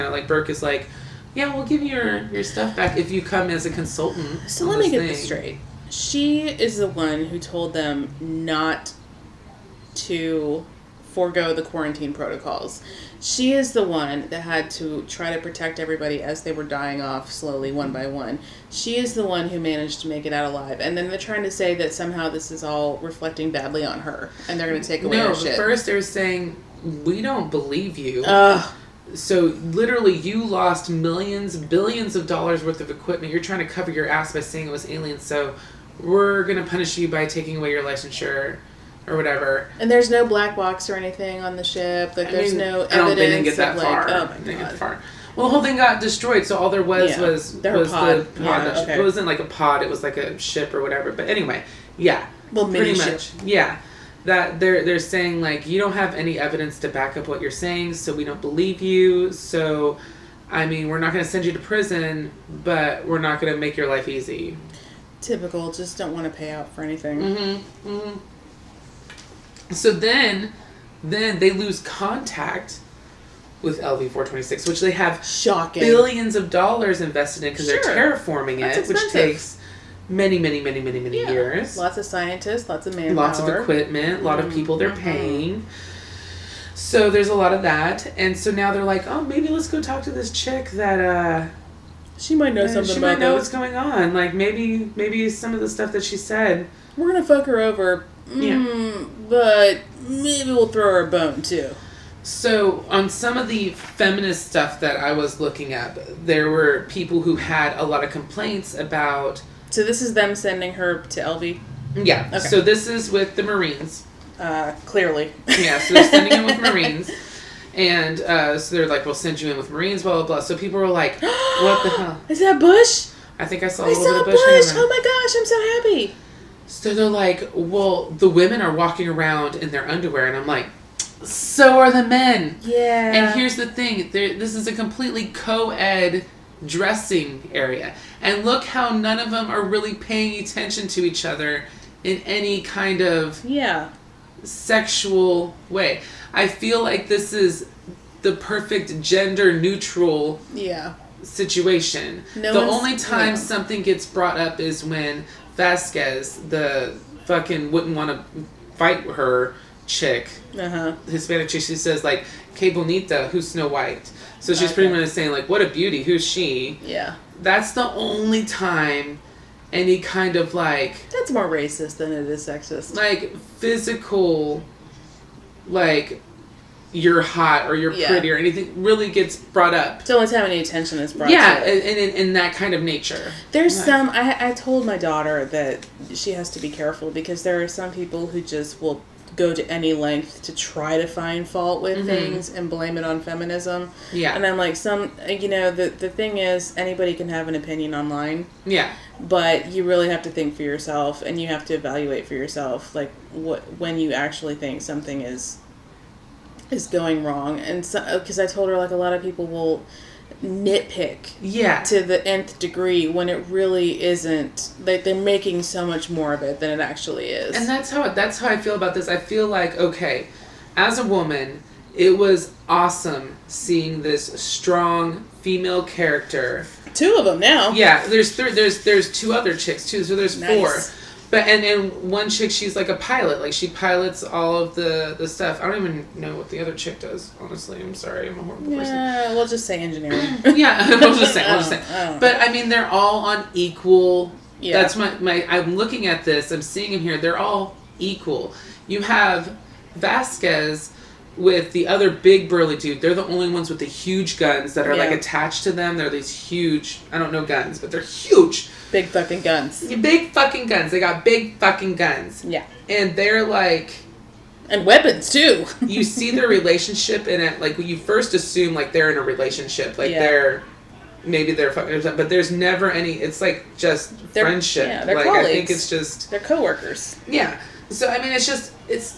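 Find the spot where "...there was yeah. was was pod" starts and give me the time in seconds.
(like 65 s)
46 s.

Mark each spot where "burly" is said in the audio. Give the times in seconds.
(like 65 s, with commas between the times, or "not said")
252 s.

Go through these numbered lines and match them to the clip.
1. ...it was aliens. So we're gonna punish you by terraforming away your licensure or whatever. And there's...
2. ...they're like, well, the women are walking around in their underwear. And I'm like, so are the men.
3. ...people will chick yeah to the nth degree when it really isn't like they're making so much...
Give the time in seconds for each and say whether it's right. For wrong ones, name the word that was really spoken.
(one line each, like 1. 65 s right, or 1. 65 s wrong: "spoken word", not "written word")
1. 34 s wrong: "taking", not "terraforming"
2. 126 s right
3. 209 s wrong: "nitpick", not "chick".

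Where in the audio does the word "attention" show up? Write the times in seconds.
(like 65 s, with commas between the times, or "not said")
140 s, 180 s.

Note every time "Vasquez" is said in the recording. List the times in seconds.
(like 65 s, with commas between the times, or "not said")
155 s, 249 s.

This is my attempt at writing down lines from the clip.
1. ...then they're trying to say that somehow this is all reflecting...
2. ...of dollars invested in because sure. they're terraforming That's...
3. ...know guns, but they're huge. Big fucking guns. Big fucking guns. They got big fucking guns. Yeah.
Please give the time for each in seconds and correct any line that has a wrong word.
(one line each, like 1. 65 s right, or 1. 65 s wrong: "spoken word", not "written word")
1. 20 s right
2. 76 s right
3. 257 s right.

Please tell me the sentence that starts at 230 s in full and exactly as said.
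four but and and one chick, she's like a pilot.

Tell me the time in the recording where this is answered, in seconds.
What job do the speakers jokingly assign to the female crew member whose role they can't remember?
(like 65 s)
239 s.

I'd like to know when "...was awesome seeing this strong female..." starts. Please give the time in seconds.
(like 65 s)
222 s.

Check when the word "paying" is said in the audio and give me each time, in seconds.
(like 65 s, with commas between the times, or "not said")
85 s, 139 s.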